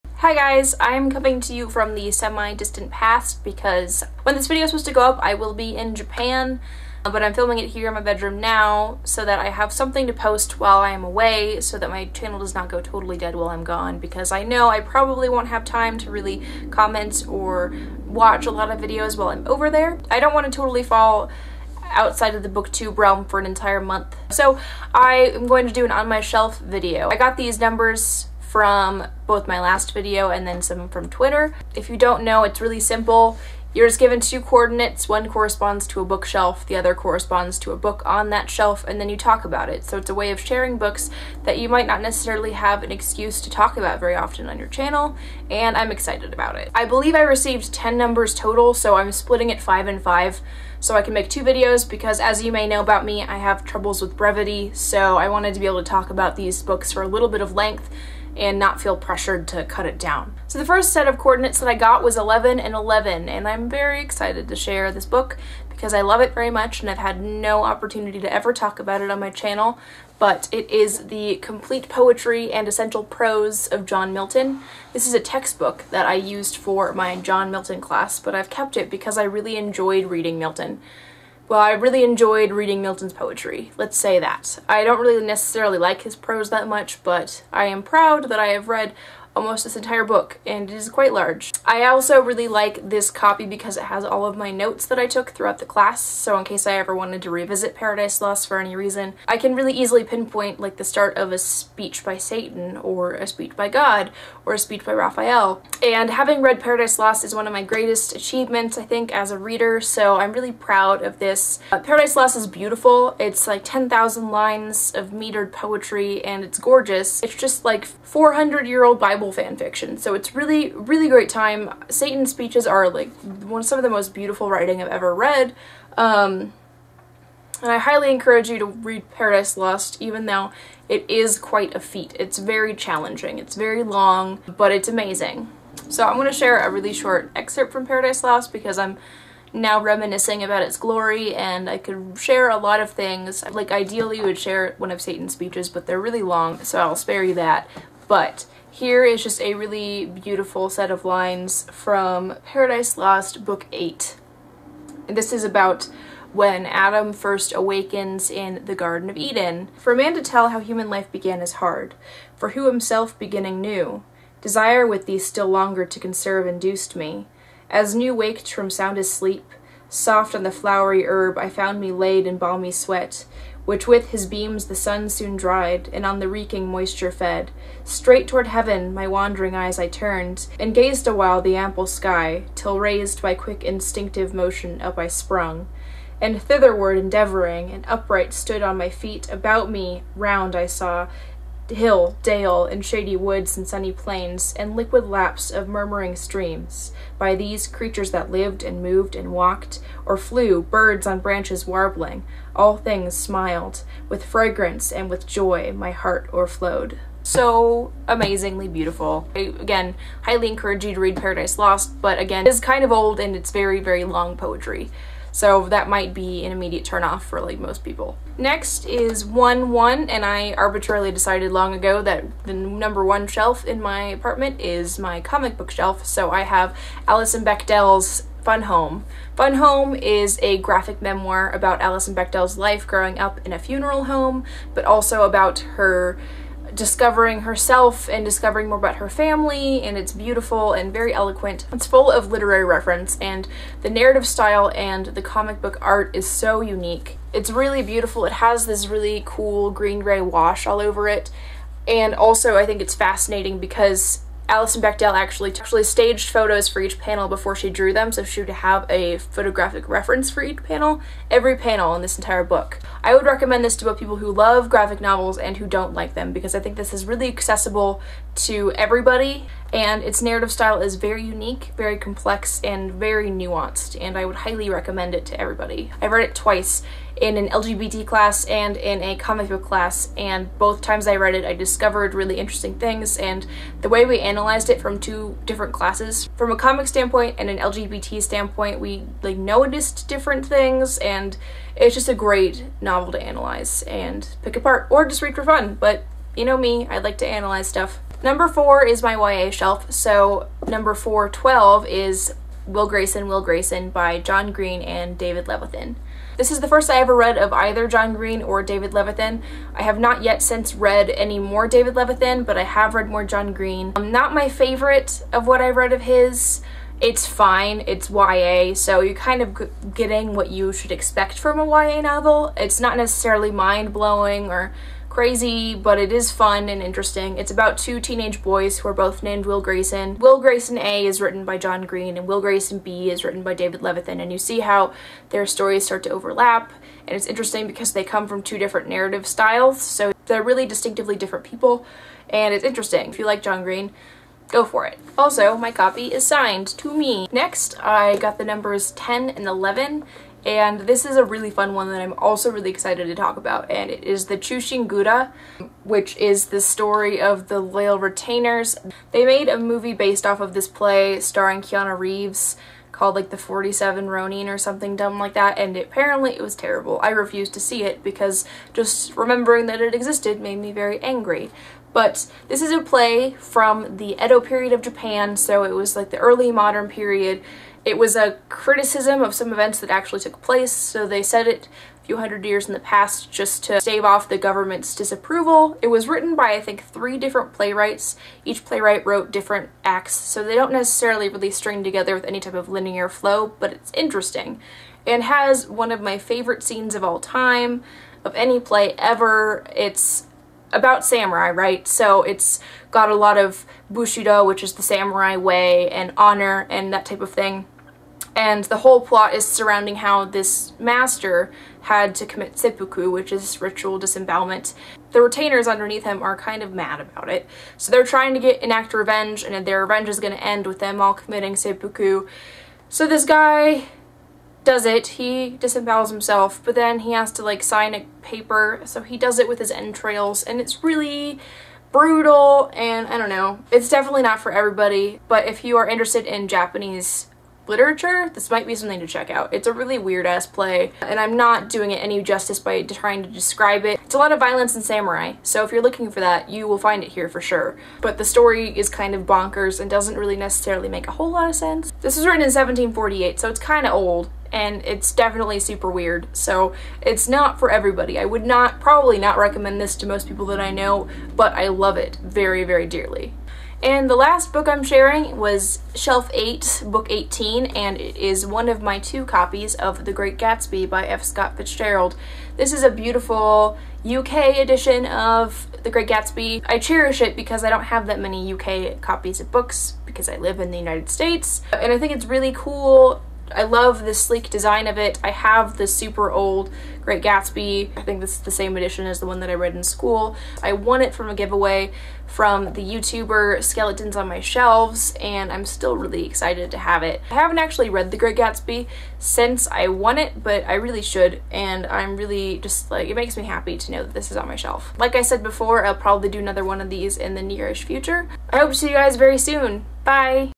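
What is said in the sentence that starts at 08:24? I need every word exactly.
Like I said before, I'll probably do another one of these in the nearish future.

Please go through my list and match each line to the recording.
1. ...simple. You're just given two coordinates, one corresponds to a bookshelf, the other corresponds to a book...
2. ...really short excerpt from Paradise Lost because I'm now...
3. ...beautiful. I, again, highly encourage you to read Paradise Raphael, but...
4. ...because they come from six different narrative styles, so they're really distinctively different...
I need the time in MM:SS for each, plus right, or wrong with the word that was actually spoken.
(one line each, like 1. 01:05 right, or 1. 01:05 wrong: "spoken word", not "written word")
1. 00:32 right
2. 02:16 right
3. 03:28 wrong: "Lost", not "Raphael"
4. 05:37 wrong: "two", not "six".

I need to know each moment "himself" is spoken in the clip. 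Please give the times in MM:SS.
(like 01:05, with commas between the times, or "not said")
02:42, 07:06.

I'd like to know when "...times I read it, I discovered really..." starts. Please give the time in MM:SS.
04:40.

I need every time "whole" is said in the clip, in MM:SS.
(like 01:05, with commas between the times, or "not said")
06:48, 07:31.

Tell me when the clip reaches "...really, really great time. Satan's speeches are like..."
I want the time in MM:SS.
02:00.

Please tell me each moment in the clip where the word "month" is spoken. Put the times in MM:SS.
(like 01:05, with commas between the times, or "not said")
00:23.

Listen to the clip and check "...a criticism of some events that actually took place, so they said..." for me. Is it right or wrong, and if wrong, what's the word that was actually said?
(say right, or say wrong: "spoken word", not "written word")
right.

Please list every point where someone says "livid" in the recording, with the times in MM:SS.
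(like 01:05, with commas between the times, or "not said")
not said.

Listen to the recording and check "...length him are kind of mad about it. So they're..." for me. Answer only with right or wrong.
wrong.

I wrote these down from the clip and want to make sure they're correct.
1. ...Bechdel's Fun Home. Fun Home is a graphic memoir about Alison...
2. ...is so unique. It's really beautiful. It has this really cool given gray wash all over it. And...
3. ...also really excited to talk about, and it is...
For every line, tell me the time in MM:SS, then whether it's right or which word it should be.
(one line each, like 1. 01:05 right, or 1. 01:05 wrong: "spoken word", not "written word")
1. 03:47 right
2. 04:06 wrong: "green", not "given"
3. 05:52 right.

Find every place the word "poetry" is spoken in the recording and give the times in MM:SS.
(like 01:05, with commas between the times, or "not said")
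01:11, 01:23, 01:55, 03:34.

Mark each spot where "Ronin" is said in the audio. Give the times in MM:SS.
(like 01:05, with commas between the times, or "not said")
06:04.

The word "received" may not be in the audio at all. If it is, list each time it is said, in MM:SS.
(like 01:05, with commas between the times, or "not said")
00:47.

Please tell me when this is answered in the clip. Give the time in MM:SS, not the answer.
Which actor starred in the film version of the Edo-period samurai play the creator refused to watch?
06:01.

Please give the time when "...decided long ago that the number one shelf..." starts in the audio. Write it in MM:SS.
03:41.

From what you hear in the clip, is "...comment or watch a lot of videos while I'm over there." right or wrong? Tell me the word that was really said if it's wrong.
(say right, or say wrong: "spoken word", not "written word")
right.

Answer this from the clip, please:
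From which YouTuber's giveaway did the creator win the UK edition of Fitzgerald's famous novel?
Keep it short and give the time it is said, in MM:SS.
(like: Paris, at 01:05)
Skeletons on My Shelves, at 08:13.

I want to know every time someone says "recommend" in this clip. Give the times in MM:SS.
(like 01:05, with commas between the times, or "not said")
04:23, 04:34, 07:39.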